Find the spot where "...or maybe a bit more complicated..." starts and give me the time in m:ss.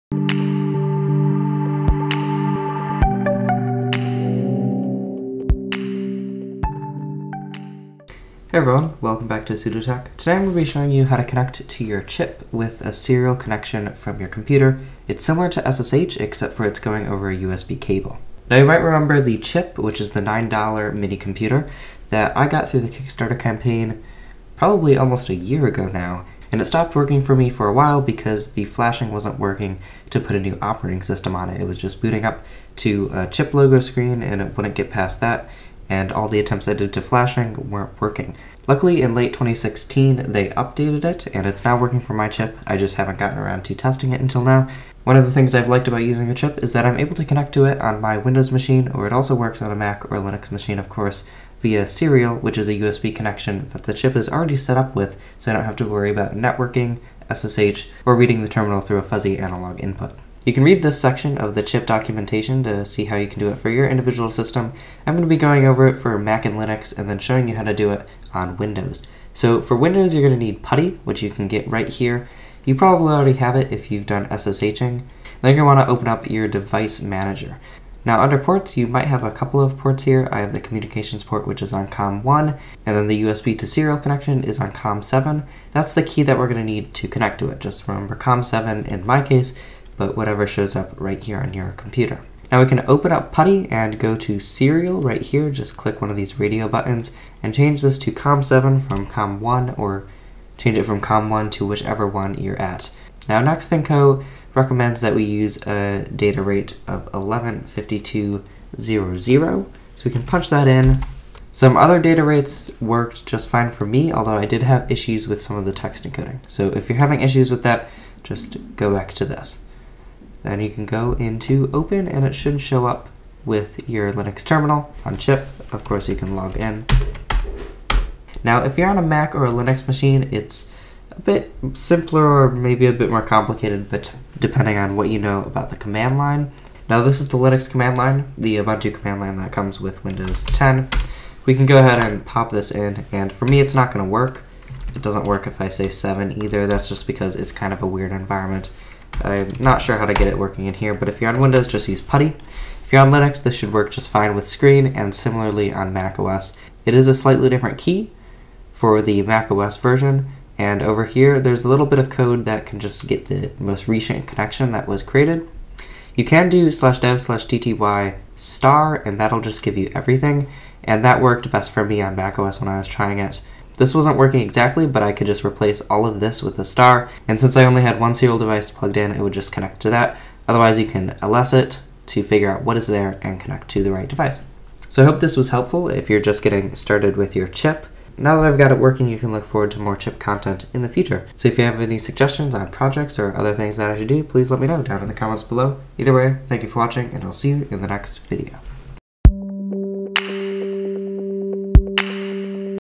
2:12.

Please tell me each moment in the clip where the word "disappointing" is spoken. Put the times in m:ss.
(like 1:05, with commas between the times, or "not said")
not said.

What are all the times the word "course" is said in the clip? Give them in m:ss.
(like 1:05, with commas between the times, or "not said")
0:50, 2:05.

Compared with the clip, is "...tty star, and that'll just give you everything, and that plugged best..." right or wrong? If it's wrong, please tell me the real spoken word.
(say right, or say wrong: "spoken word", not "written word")
wrong: "worked", not "plugged".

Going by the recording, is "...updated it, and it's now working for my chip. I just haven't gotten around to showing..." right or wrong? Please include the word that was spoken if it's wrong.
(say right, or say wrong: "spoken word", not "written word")
wrong: "testing", not "showing".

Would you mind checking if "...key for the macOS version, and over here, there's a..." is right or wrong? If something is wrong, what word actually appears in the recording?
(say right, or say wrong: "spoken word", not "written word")
right.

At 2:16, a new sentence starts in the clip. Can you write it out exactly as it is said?
Now, this is the Linux command line, the Ubuntu command line that comes with Windows 10.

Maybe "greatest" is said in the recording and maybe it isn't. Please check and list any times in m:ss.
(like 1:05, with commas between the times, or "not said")
not said.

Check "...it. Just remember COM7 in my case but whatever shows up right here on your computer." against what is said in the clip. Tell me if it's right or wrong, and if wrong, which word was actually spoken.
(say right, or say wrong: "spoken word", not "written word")
right.